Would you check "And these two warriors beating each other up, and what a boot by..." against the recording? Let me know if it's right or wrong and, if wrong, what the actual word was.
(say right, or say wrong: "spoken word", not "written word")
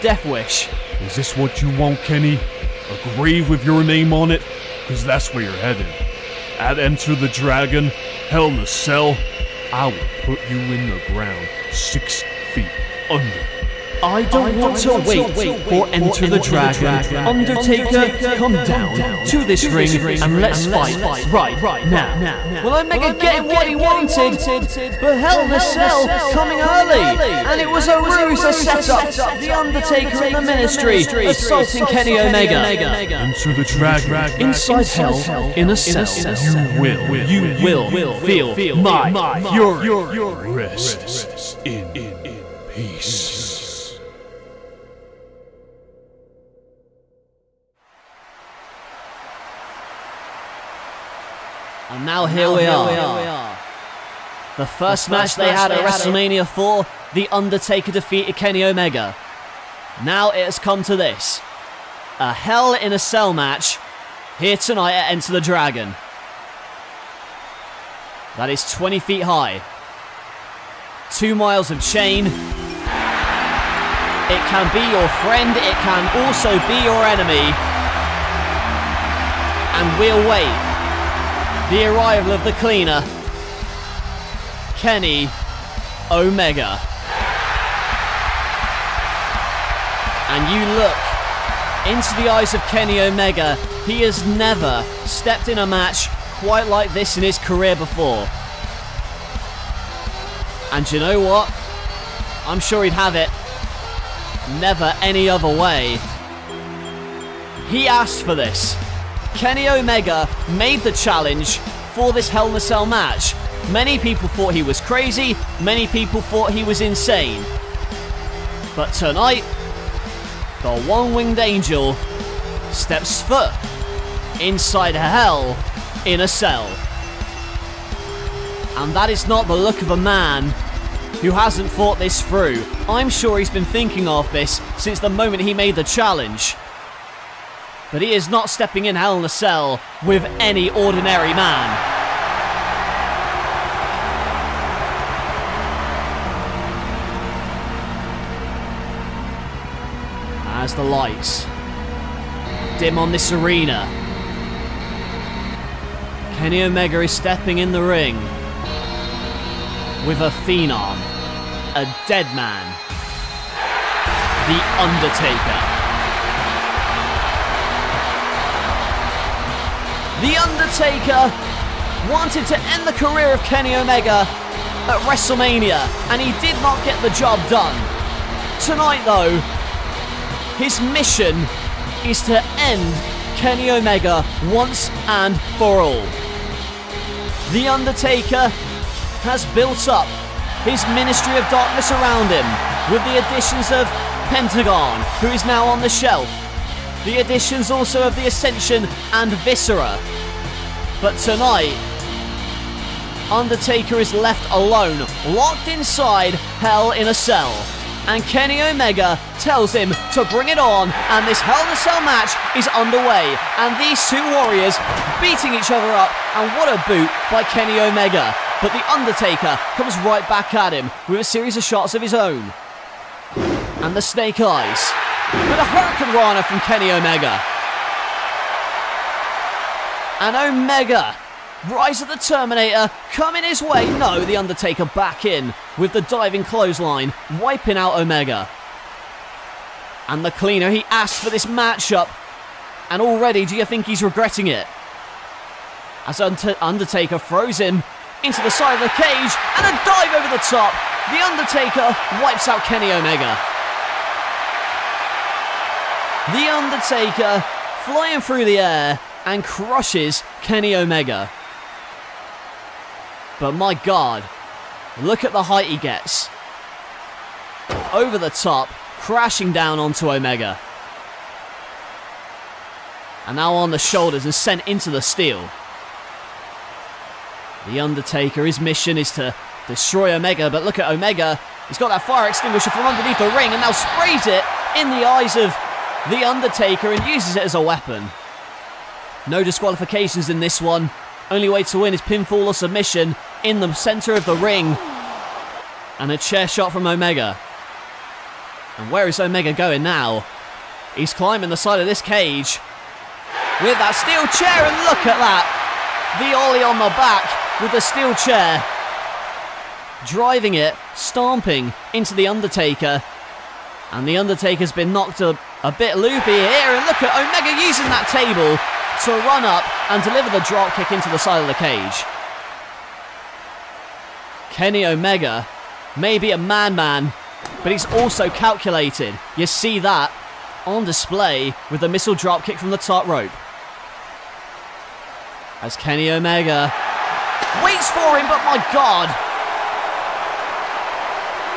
right.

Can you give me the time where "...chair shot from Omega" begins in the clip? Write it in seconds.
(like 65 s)
296 s.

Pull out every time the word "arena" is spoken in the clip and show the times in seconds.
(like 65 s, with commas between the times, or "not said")
153 s.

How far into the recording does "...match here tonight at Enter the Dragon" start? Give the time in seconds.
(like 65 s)
63 s.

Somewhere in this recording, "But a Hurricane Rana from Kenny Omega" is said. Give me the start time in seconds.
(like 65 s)
225 s.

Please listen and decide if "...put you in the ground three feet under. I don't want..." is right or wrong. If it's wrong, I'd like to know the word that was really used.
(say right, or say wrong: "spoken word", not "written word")
wrong: "six", not "three".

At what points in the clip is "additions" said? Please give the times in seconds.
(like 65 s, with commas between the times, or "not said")
193 s, 197 s.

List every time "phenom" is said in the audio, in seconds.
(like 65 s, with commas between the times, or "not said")
160 s.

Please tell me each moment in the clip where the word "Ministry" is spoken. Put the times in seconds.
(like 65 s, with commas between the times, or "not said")
30 s, 190 s.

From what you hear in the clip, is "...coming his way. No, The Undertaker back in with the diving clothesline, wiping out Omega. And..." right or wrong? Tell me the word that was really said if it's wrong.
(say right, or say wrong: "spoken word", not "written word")
right.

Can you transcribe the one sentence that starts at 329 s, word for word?
You see that on display with the missile drop kick from the top rope.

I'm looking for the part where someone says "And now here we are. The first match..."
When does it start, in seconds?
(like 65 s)
51 s.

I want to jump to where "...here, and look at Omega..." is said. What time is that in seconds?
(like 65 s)
316 s.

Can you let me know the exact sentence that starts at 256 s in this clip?
The Undertaker flying through the air and crushes Kenny Omega.